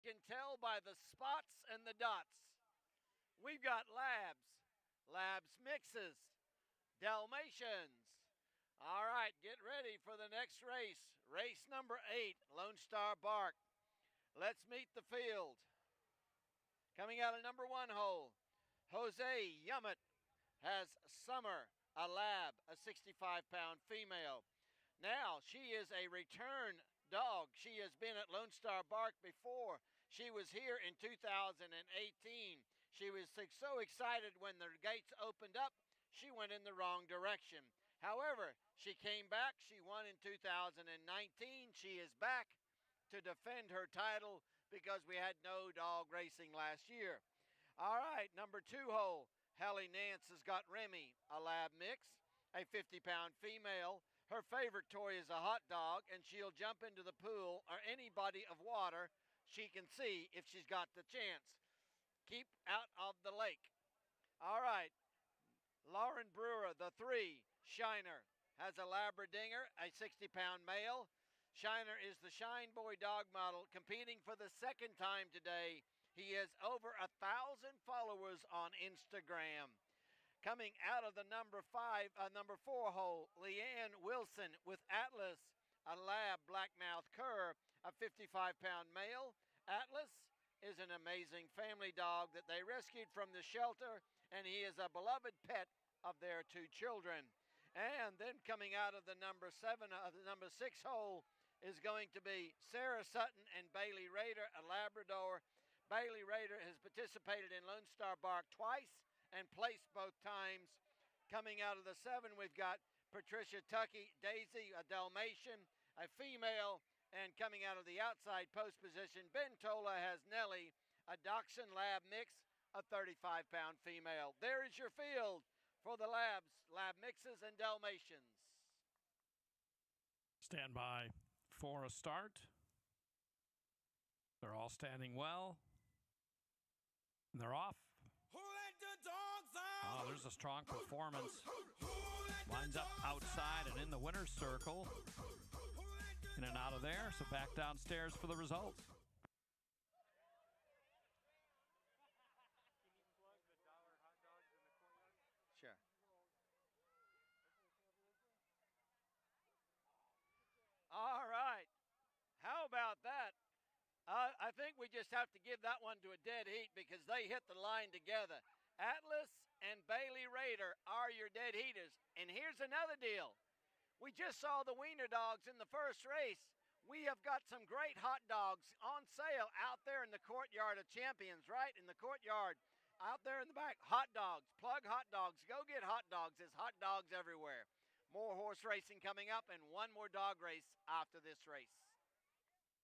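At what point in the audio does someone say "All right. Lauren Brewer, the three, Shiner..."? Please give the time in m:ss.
1:04.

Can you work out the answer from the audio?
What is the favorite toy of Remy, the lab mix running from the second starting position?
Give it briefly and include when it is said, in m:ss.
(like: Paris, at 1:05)
A hot dog, at 0:55.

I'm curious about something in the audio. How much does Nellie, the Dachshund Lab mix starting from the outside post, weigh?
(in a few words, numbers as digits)
35 pounds.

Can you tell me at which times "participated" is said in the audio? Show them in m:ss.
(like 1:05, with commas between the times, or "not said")
1:46.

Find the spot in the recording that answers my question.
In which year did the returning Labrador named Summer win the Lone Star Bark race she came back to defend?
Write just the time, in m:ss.
0:40.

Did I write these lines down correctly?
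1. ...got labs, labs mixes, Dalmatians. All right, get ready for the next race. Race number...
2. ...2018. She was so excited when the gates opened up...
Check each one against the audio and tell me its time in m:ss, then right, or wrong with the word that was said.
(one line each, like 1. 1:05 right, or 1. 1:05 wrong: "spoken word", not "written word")
1. 0:03 right
2. 0:30 right.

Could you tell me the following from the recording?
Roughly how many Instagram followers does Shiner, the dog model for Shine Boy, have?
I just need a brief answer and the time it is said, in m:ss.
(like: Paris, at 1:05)
Over 1,000, at 1:16.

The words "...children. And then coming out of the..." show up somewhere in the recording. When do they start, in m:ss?
1:36.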